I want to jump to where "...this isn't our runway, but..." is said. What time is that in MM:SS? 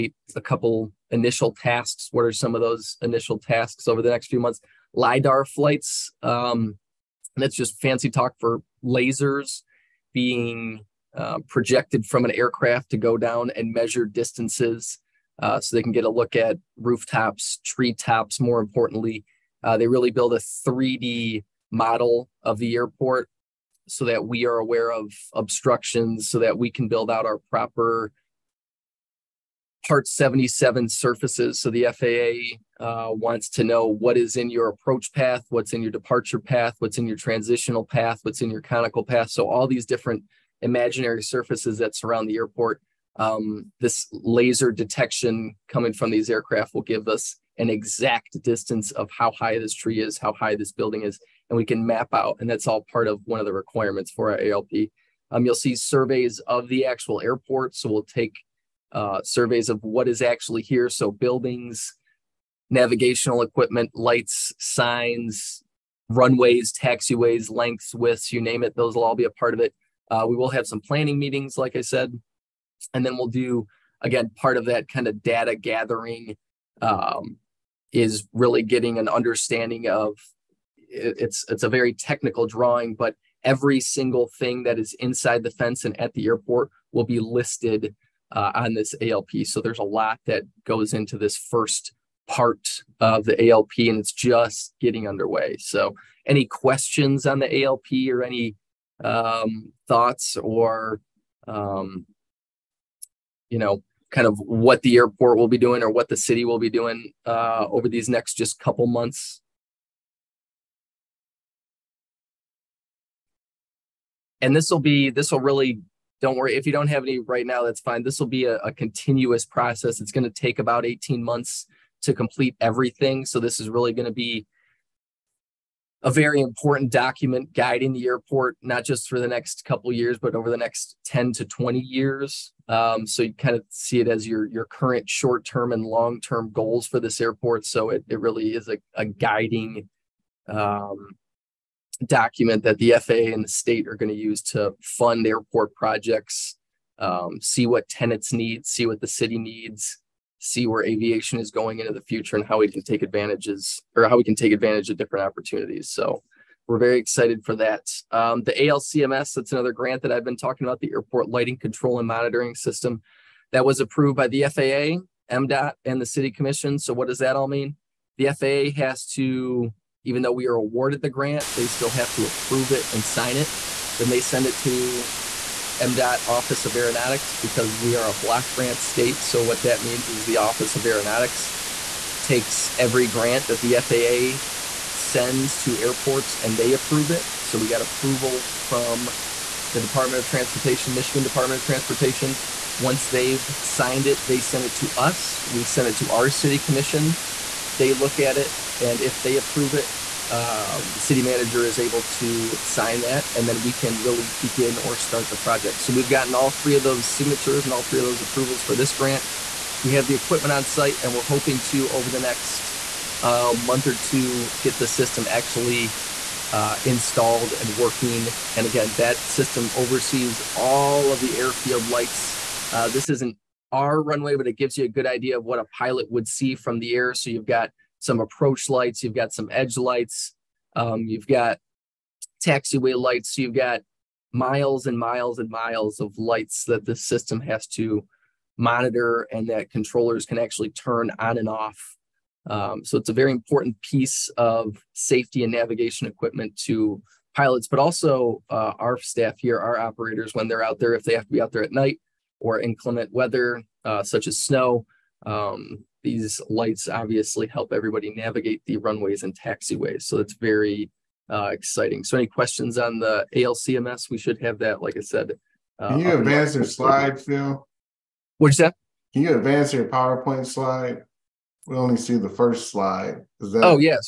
03:42.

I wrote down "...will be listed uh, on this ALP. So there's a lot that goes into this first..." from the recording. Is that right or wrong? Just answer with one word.
right.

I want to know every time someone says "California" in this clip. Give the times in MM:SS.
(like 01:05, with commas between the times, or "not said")
not said.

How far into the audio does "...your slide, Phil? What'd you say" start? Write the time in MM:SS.
04:26.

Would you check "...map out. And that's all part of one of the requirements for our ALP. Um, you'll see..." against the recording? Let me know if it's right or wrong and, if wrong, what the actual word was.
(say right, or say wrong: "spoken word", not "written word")
right.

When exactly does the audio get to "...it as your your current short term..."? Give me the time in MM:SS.
02:13.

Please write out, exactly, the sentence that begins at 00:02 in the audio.
What are some of those initial tasks over the next few months?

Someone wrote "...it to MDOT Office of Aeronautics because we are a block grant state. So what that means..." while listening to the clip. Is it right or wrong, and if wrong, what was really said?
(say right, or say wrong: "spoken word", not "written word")
right.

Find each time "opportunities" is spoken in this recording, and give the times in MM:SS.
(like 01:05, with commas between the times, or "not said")
02:35.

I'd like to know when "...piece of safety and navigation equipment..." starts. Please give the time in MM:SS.
04:03.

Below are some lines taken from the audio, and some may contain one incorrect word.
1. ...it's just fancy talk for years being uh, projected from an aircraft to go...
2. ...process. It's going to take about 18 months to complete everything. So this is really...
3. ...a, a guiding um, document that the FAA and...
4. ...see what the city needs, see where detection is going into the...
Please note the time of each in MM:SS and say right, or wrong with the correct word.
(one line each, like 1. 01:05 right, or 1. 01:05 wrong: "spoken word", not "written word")
1. 00:07 wrong: "lasers", not "years"
2. 01:59 right
3. 02:18 right
4. 02:28 wrong: "aviation", not "detection".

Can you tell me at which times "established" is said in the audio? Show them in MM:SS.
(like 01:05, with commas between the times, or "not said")
not said.